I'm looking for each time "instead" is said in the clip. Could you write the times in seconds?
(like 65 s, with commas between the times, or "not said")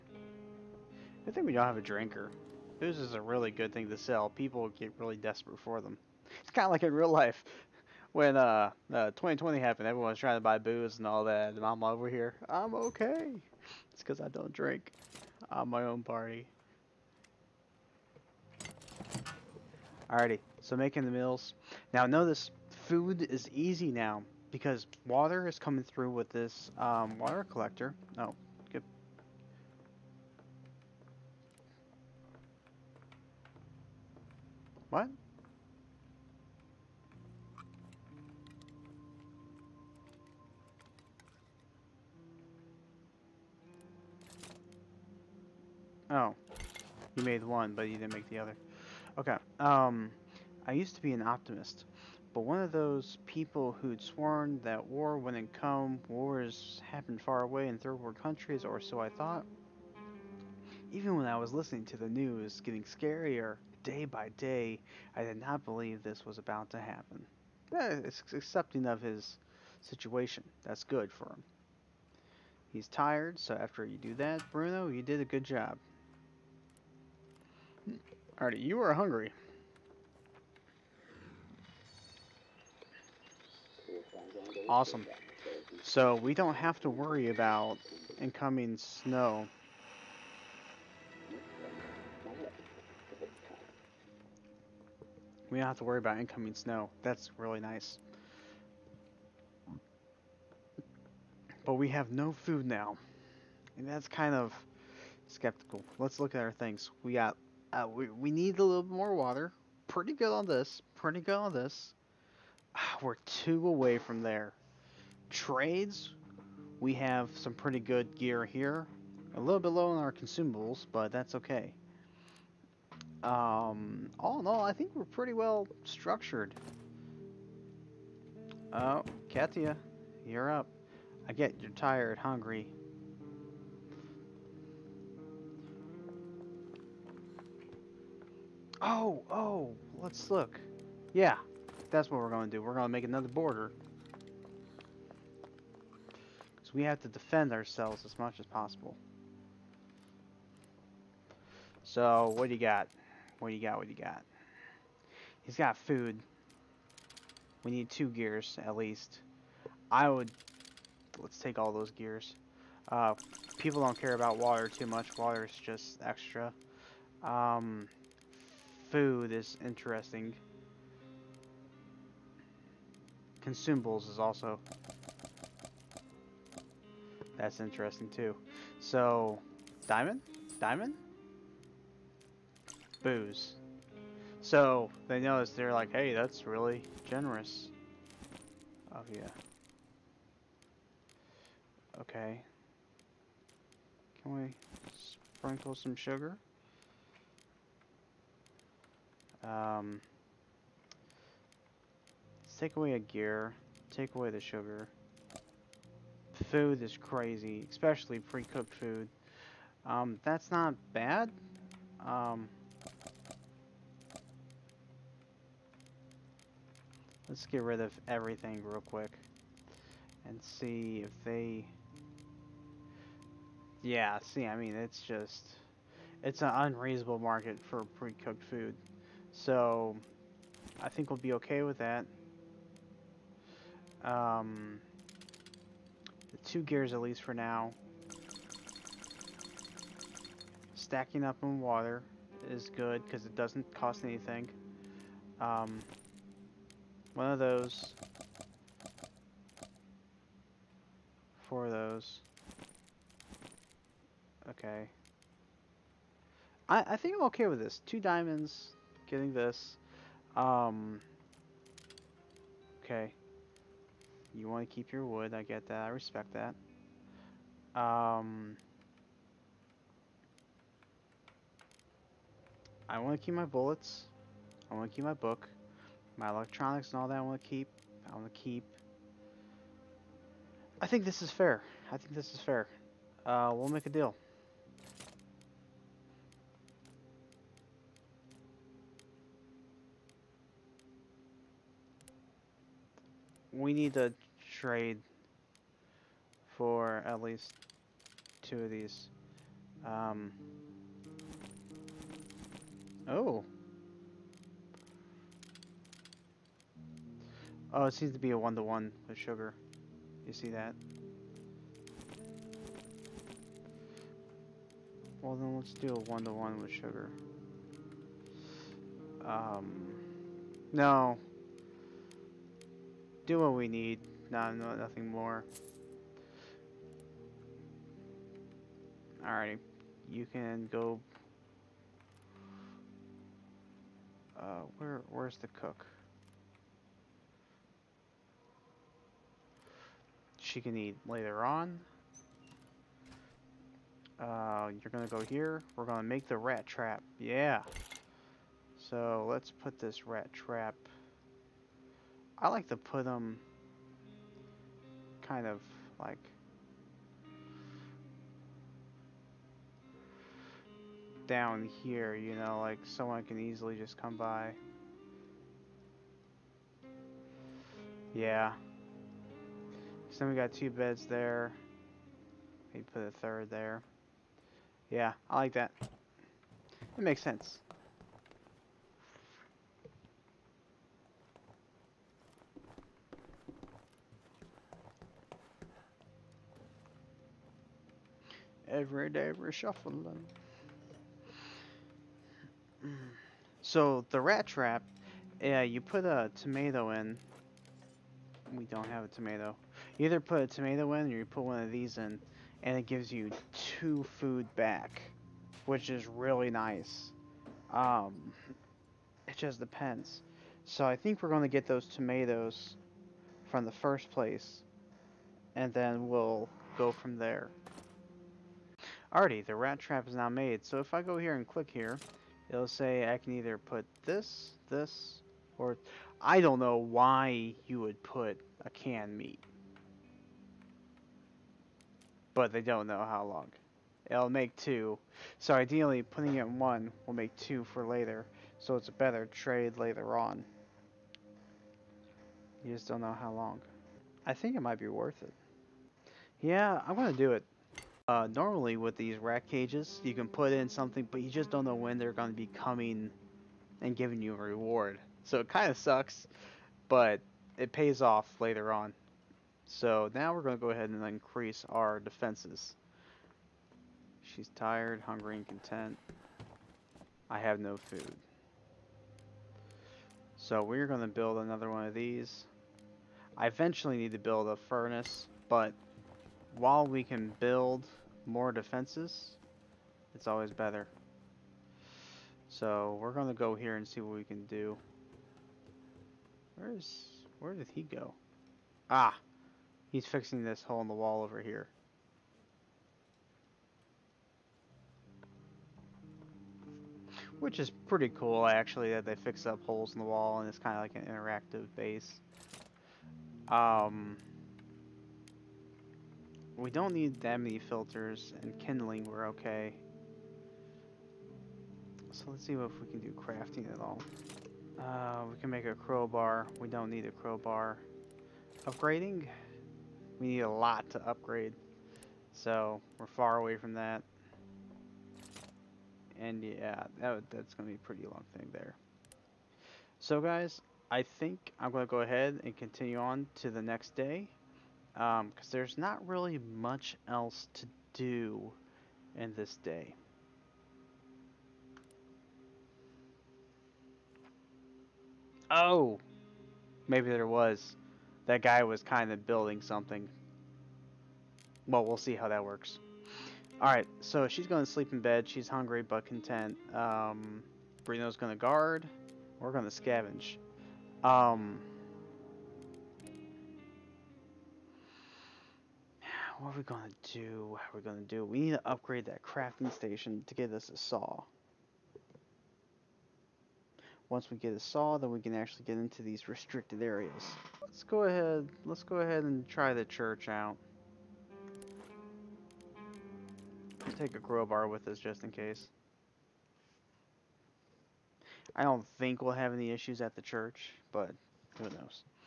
not said.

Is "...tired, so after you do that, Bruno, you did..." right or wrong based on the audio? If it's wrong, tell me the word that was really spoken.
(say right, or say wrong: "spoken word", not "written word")
right.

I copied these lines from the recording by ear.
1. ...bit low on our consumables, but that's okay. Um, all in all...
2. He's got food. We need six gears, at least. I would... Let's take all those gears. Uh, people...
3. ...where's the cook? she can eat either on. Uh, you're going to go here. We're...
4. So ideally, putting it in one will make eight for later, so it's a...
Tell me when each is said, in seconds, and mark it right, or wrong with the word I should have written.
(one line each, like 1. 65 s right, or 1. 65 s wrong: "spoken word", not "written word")
1. 119 s right
2. 155 s wrong: "two", not "six"
3. 335 s wrong: "later", not "either"
4. 435 s wrong: "two", not "eight".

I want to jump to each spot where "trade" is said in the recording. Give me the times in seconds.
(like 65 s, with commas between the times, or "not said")
115 s, 294 s, 439 s.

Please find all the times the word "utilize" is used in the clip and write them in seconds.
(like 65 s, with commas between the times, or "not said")
not said.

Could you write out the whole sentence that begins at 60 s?
Even when I was listening to the news, getting scarier day by day, I did not believe this was about to happen.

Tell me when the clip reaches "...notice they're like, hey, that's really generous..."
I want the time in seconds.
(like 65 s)
185 s.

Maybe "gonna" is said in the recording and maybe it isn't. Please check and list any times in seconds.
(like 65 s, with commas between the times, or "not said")
446 s, 452 s.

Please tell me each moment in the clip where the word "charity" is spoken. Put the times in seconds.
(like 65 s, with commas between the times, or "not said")
not said.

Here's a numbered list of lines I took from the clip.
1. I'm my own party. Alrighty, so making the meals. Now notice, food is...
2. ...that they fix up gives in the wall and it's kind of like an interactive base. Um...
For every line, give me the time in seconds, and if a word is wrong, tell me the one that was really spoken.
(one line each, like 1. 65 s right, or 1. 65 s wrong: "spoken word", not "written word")
1. 15 s right
2. 498 s wrong: "holes", not "gives".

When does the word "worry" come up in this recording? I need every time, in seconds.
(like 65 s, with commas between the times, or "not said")
86 s, 95 s.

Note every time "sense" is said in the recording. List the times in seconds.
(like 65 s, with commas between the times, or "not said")
377 s.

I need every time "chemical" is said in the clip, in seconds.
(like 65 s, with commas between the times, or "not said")
not said.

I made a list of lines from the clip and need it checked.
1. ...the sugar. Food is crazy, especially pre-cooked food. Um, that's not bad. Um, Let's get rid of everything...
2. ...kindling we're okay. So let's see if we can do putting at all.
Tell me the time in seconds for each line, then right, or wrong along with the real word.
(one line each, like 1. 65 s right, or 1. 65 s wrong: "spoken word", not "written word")
1. 204 s right
2. 508 s wrong: "crafting", not "putting".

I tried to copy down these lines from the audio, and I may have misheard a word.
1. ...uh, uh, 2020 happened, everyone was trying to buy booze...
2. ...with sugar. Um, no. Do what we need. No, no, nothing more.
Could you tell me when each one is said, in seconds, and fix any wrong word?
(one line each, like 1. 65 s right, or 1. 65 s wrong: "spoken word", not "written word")
1. 8 s right
2. 316 s right.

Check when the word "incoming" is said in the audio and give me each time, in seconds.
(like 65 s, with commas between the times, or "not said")
88 s, 96 s.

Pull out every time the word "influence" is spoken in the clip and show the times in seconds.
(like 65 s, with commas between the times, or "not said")
not said.